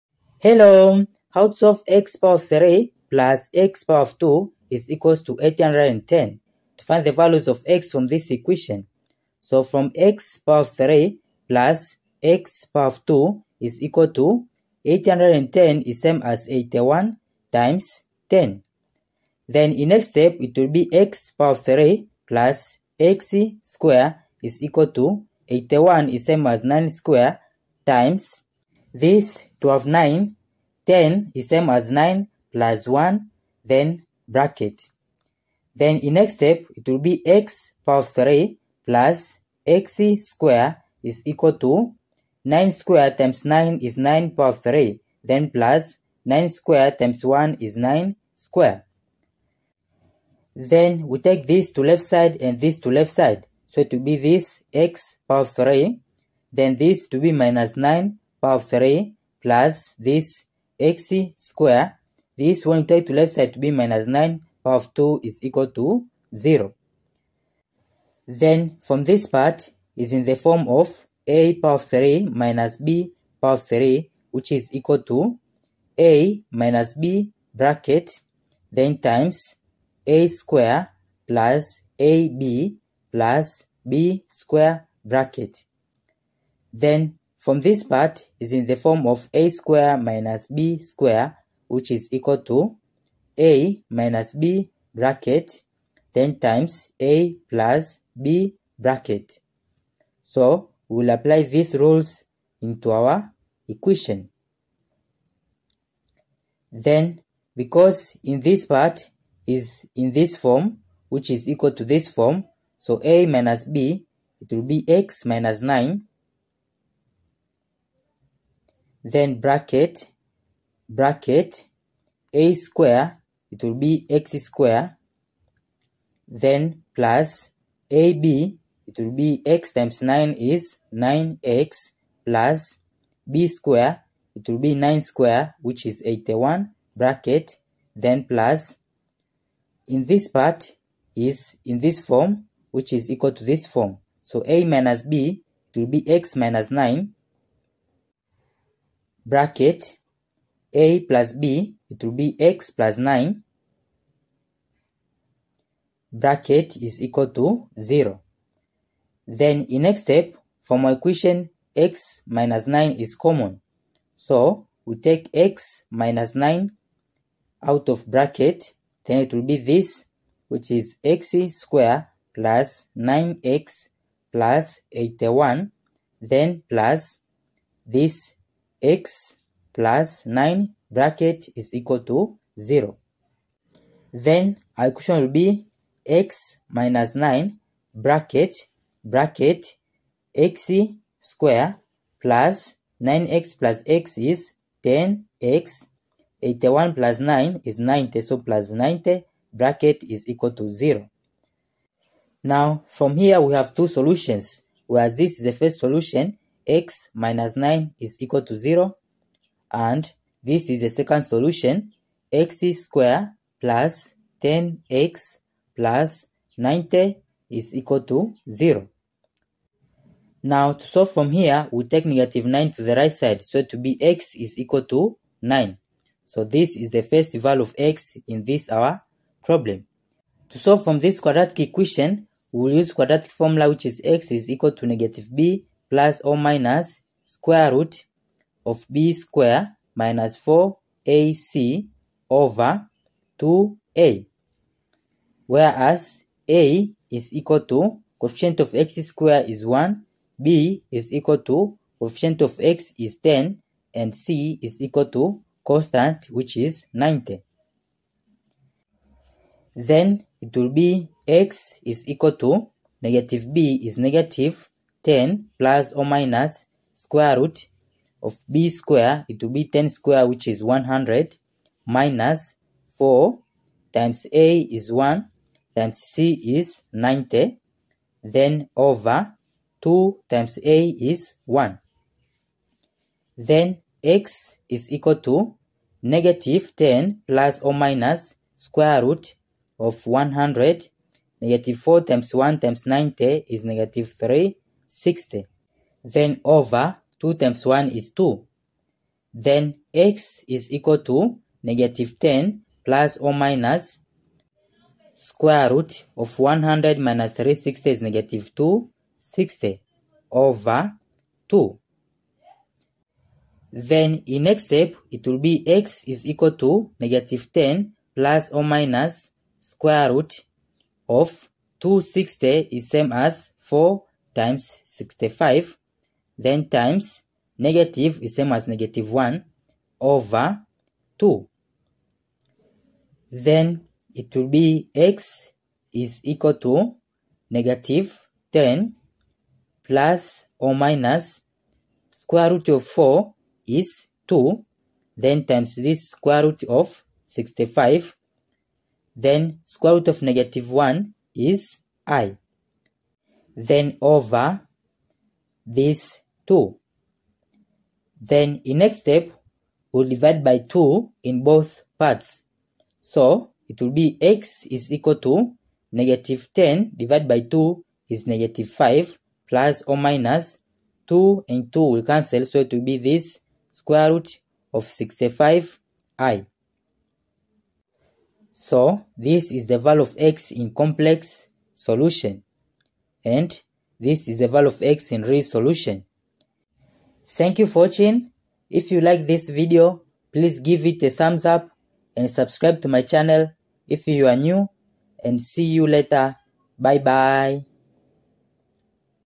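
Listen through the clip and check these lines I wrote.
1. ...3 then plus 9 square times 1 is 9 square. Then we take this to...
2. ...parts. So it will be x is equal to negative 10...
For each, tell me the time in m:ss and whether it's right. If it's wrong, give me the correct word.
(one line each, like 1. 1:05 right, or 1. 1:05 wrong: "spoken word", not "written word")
1. 0:44 right
2. 6:01 right.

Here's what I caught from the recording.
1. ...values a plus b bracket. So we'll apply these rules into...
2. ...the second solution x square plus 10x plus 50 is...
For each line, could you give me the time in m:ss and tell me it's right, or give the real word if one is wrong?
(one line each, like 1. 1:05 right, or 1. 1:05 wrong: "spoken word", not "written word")
1. 1:36 wrong: "times", not "values"
2. 3:30 wrong: "90", not "50".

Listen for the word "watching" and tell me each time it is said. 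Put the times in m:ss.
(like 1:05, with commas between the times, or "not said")
6:27.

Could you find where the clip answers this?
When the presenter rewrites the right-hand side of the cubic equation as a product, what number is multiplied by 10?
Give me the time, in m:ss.
0:16.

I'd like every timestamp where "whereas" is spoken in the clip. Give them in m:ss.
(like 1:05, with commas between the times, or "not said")
3:24, 4:05.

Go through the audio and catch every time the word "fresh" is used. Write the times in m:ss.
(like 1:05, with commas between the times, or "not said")
not said.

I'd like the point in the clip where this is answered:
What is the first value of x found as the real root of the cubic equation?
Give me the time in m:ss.
3:44.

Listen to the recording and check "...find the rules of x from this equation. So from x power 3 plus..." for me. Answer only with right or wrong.
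wrong.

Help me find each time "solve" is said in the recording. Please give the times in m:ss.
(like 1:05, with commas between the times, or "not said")
3:40, 3:50.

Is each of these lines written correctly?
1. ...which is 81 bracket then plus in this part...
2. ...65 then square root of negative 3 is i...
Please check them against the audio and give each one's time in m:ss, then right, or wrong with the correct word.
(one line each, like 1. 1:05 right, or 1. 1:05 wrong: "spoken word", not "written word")
1. 2:15 right
2. 5:47 wrong: "1", not "3".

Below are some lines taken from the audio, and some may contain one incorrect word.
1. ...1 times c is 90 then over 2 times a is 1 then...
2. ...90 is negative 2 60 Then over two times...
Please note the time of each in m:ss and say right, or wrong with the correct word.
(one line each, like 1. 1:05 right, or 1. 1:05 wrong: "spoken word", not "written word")
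1. 4:34 right
2. 4:52 wrong: "3", not "2".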